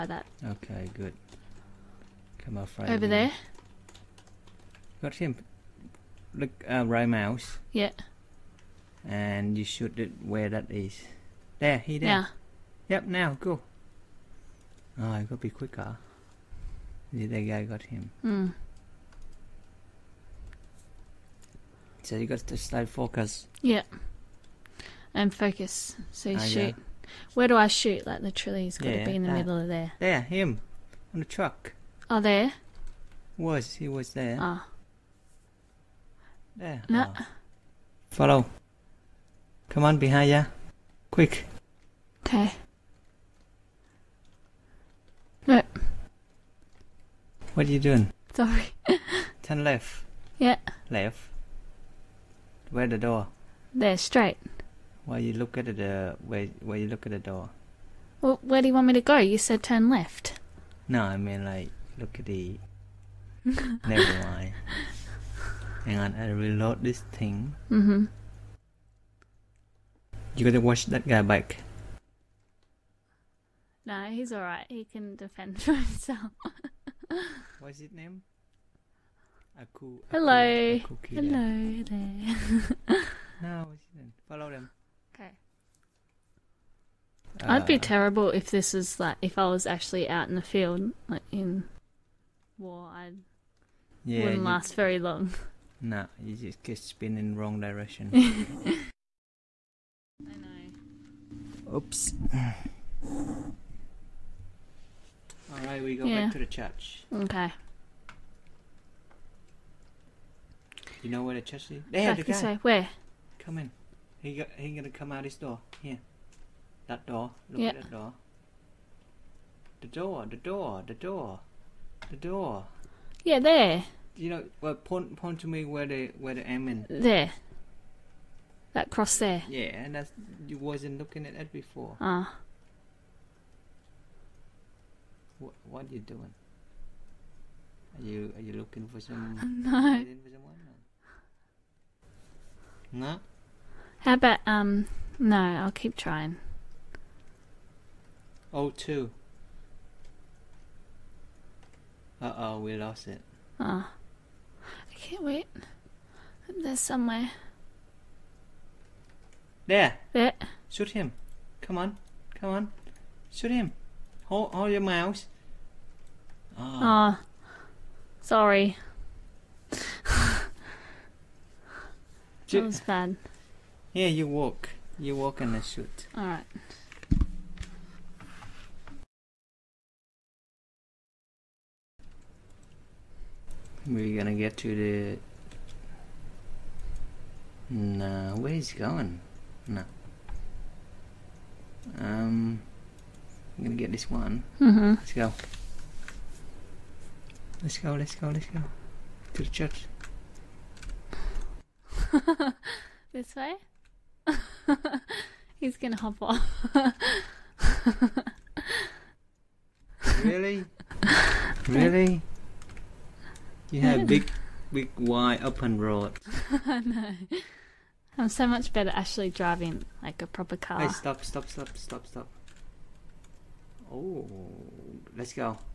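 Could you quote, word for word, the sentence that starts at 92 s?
I yeah, wouldn't last very long.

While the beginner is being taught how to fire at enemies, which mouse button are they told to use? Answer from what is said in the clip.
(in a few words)
Right mouse.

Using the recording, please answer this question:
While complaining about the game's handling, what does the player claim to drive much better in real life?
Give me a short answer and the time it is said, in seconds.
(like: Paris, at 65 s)
A proper car, at 220 s.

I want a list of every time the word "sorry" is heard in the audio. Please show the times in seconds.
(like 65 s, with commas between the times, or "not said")
48 s, 168 s.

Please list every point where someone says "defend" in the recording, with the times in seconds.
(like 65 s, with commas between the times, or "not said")
75 s.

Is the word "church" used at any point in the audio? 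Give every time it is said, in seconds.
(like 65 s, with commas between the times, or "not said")
106 s, 199 s.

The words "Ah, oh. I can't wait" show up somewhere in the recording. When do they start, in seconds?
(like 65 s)
153 s.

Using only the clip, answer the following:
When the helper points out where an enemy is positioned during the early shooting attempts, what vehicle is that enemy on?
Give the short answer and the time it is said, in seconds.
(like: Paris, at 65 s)
Truck, at 31 s.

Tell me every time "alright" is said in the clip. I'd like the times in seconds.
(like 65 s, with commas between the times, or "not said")
74 s, 176 s.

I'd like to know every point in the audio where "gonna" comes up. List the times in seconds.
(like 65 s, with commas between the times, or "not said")
114 s, 184 s, 193 s, 205 s.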